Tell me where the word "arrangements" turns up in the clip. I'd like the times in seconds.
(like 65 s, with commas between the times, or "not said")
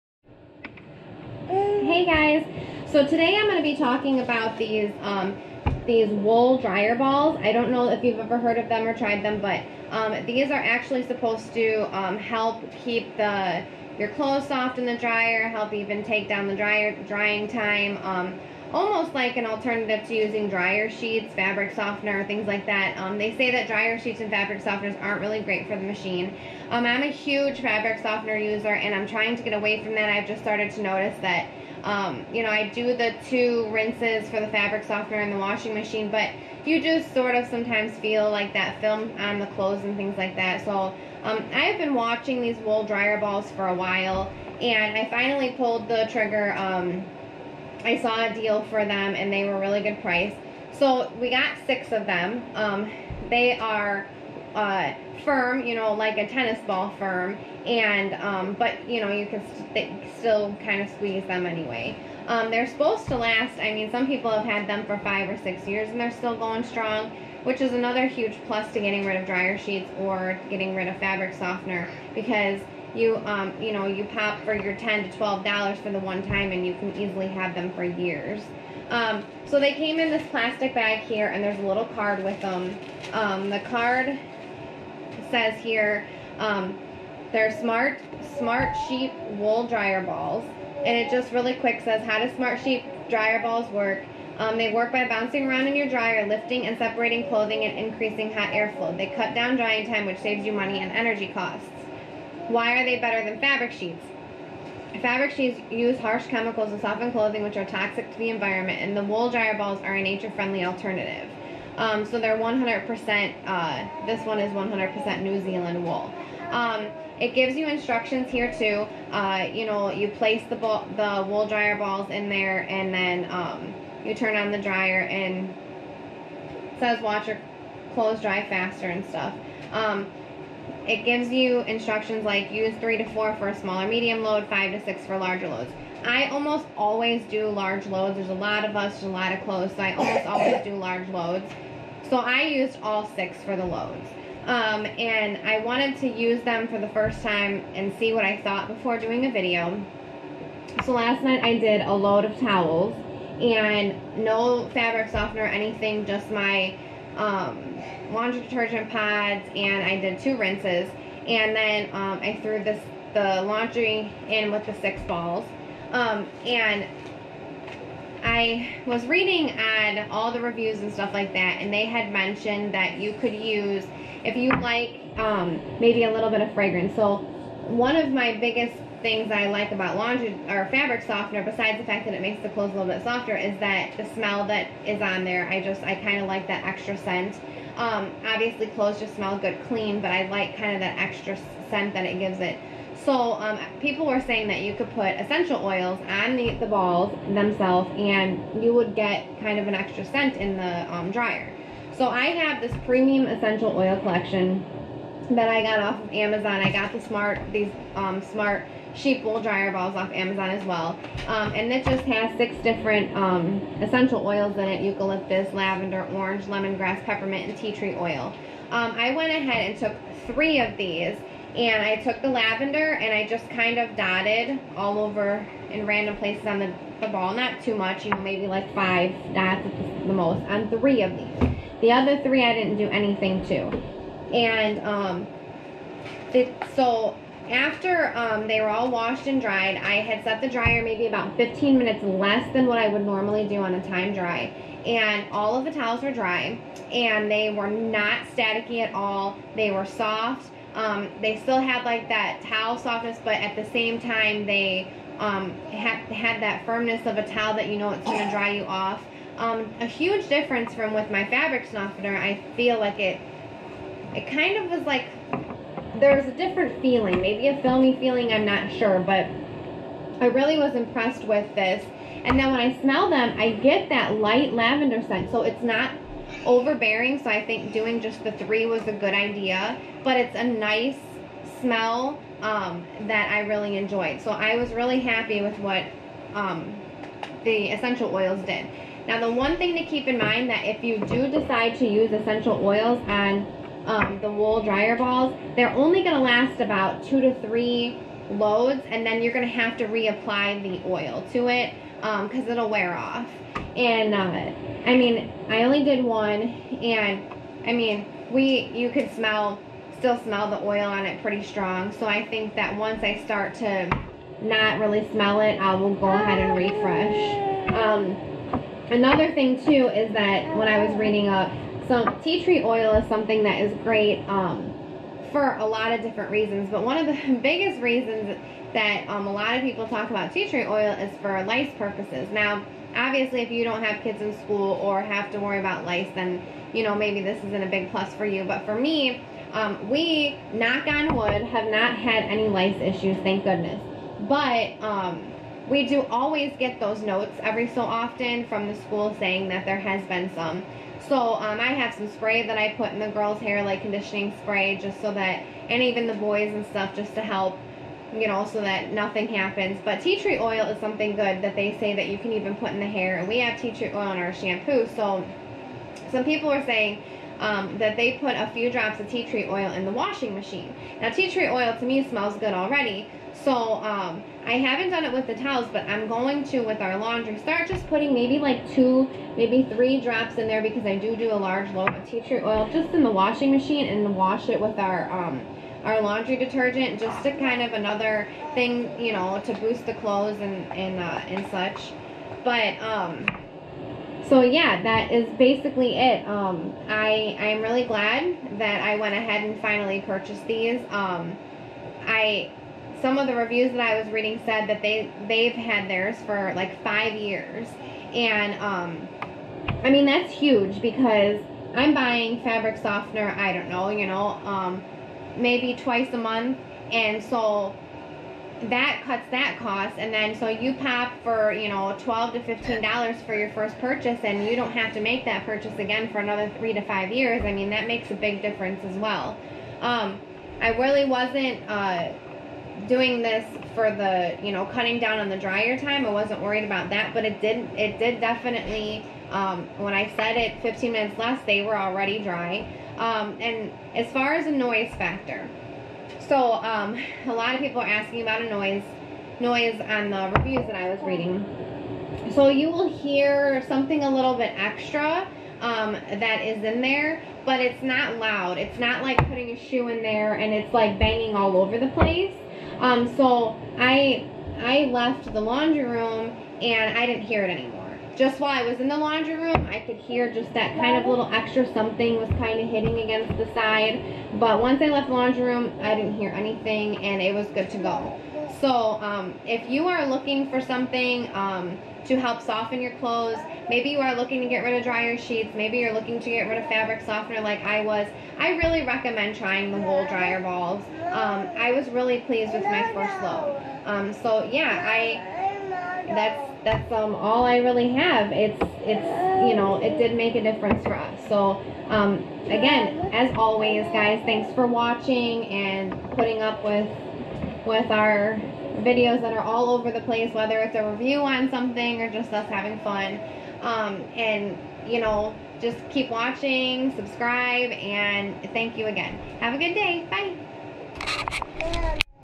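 not said.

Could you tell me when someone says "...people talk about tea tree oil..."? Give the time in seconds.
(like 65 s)
329 s.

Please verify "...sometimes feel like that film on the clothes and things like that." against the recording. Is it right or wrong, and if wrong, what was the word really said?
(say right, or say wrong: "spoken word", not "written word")
right.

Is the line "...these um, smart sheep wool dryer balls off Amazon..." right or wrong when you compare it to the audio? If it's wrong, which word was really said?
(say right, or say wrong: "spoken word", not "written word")
right.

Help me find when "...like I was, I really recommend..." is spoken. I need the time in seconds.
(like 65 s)
487 s.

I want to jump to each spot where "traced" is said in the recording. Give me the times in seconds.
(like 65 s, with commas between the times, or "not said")
not said.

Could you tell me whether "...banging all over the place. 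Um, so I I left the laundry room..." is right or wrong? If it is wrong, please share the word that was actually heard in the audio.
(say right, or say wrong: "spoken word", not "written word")
right.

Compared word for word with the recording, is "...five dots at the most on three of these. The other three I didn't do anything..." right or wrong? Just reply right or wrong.
right.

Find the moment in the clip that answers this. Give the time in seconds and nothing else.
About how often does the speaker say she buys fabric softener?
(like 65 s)
415 s.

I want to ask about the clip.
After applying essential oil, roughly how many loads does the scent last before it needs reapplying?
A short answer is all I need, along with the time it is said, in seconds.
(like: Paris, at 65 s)
2 to 3, at 297 s.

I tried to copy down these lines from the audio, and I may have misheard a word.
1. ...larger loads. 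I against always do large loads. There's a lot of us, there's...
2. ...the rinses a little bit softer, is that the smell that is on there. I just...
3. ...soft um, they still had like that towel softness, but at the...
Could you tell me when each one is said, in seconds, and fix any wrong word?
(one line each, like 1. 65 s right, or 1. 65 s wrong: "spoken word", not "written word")
1. 135 s wrong: "almost", not "against"
2. 182 s wrong: "clothes", not "rinses"
3. 249 s right.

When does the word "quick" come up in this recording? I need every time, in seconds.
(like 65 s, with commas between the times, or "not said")
91 s.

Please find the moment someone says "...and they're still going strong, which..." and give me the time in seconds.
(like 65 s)
65 s.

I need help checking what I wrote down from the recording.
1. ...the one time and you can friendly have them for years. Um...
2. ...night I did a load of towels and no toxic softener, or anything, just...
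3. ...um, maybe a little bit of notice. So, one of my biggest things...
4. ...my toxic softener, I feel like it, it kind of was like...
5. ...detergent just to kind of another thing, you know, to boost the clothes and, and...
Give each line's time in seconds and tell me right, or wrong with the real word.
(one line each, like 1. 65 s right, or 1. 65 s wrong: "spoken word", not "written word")
1. 75 s wrong: "easily", not "friendly"
2. 151 s wrong: "fabric", not "toxic"
3. 175 s wrong: "fragrance", not "notice"
4. 261 s wrong: "fabric", not "toxic"
5. 386 s right.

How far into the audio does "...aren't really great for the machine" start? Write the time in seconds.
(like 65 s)
25 s.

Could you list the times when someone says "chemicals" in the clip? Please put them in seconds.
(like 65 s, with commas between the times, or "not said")
106 s.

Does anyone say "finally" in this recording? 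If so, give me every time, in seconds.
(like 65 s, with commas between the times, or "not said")
45 s, 399 s.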